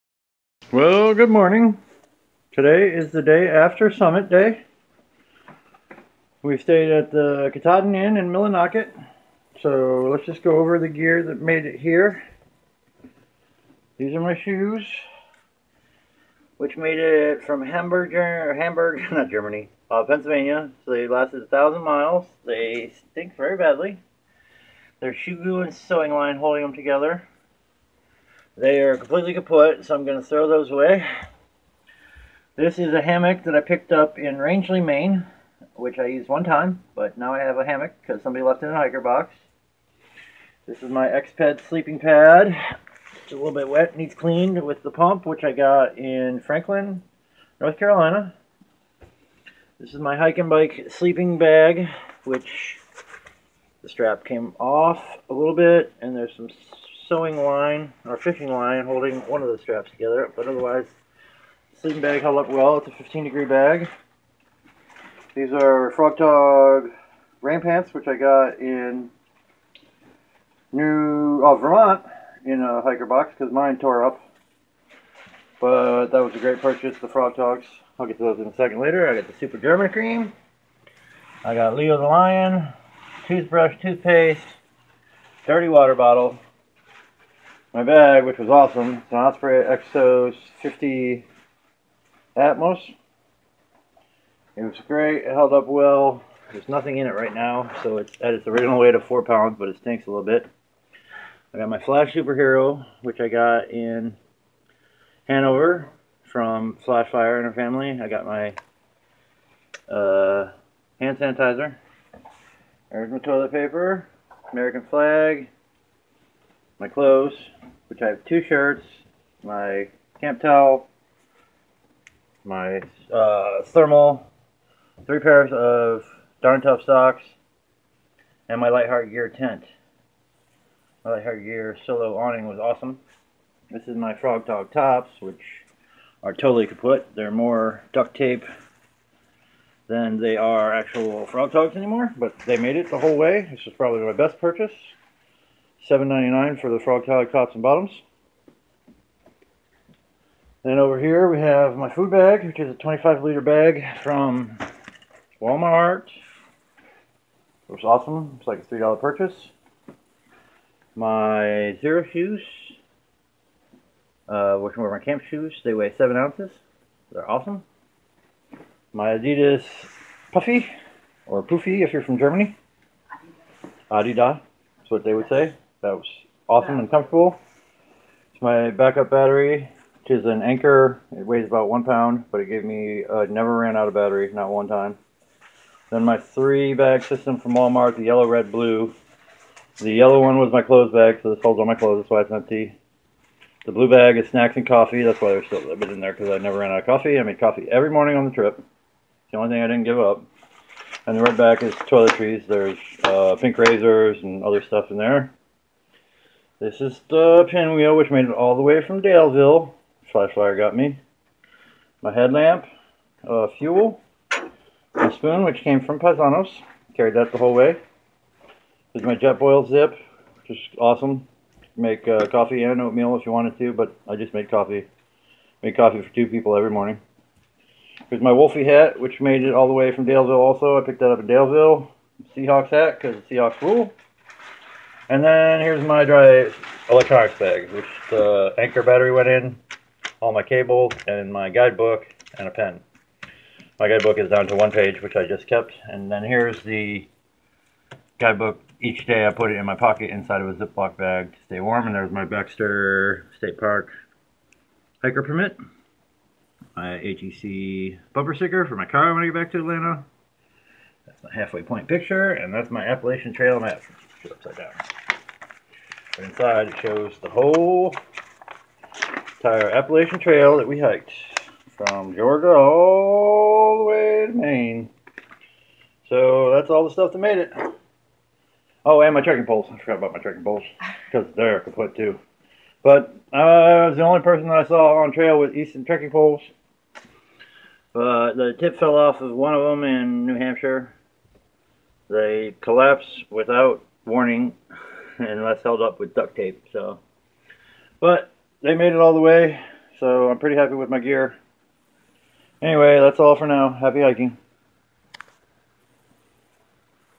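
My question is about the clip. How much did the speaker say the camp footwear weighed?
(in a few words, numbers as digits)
7 ounces.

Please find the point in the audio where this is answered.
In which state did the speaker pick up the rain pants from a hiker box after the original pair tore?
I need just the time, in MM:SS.
01:11.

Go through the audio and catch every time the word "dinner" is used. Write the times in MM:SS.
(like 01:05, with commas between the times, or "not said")
not said.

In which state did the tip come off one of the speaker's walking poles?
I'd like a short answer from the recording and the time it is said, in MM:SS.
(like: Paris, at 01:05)
New Hampshire, at 04:50.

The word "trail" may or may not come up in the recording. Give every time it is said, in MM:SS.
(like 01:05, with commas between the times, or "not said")
04:23, 04:30, 04:45.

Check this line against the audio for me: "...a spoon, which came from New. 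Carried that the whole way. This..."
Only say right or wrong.
wrong.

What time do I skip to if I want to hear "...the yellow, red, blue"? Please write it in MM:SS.
03:07.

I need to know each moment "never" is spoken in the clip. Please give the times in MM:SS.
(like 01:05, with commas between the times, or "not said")
03:03, 03:16.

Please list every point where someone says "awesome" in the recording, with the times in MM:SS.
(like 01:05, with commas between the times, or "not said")
01:28, 02:12, 02:37, 02:47, 02:56, 03:40.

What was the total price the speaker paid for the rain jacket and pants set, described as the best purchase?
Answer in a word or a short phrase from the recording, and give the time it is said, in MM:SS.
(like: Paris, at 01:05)
$7.99, at 02:25.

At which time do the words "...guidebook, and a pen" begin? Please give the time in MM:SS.
04:01.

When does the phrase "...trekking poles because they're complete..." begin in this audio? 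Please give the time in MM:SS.
04:40.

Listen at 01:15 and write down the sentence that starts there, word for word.
But that was a great purchase, the Frogg Toggs.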